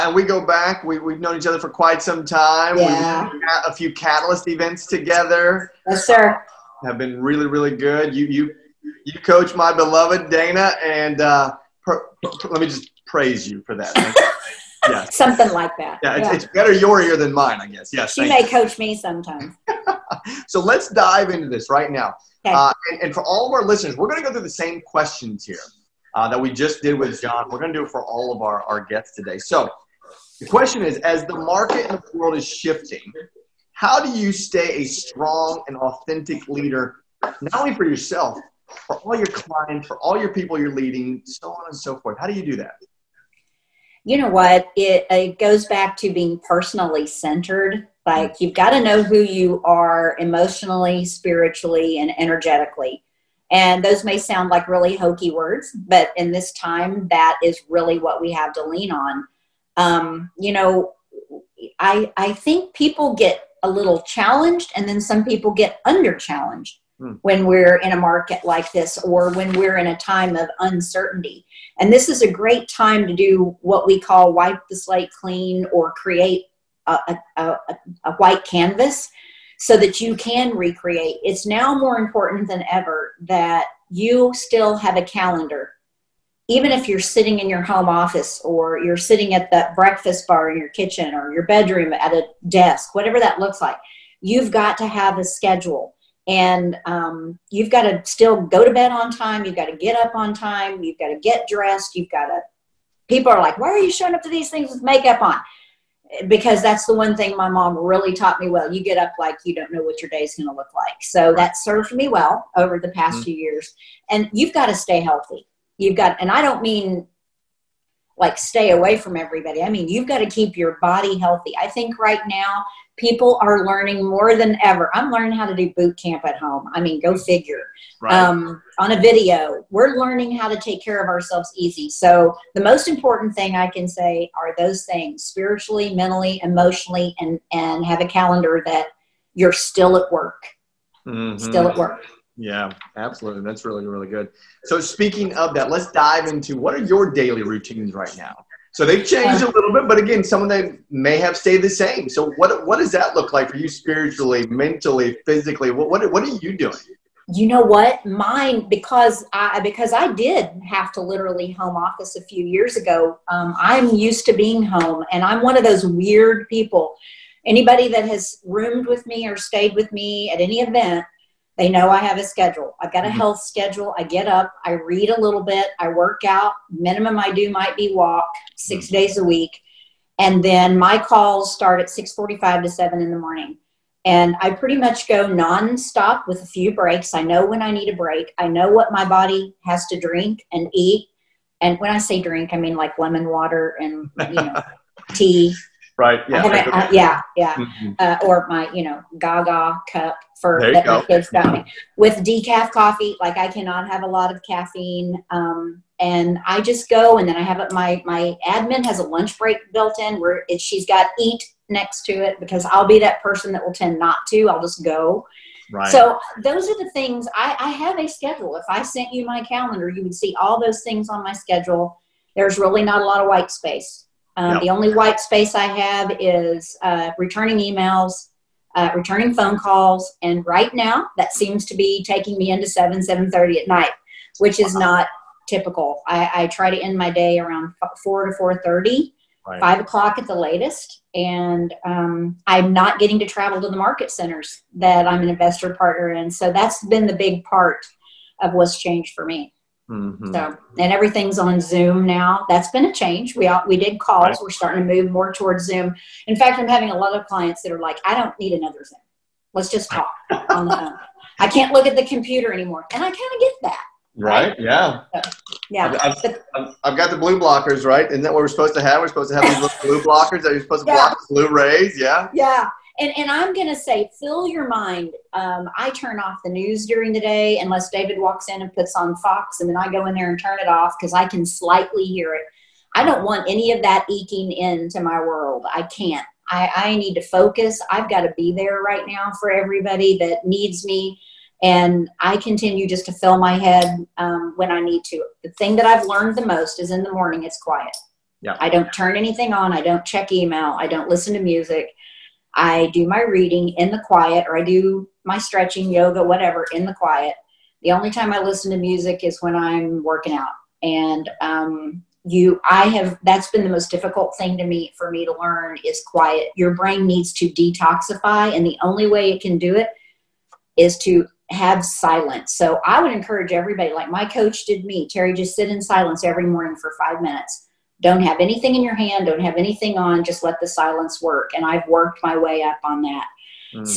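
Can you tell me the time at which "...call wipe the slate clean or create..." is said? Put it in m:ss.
1:14.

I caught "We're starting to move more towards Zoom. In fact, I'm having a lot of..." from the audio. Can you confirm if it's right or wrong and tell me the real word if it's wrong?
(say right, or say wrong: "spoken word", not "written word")
right.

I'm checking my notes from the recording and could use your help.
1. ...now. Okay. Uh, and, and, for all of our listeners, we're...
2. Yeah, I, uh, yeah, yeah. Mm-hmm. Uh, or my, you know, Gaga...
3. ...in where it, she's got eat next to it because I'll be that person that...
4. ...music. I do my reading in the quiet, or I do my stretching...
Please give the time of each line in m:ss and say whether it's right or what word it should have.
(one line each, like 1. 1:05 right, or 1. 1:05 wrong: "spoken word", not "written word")
1. 0:21 right
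2. 3:16 right
3. 3:29 right
4. 5:01 right.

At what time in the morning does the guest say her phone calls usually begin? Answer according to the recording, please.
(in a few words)
6:45.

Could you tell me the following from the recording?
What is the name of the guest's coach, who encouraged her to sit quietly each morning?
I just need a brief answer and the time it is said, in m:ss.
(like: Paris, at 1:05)
Terri, at 5:25.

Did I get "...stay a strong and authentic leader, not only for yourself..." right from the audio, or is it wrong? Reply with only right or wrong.
right.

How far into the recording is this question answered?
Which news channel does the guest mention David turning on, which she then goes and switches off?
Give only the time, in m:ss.
4:39.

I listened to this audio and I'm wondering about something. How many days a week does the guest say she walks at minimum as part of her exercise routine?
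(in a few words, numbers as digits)
6.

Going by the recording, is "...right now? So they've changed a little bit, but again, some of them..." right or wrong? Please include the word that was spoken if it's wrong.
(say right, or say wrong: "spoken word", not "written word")
right.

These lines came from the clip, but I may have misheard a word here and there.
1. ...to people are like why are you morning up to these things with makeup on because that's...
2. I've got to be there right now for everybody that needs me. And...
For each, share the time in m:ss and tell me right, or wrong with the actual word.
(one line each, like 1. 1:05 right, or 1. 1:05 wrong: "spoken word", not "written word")
1. 1:42 wrong: "showing", not "morning"
2. 4:47 right.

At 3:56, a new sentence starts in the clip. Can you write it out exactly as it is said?
I, I, try to end my day around four to four thirty, right.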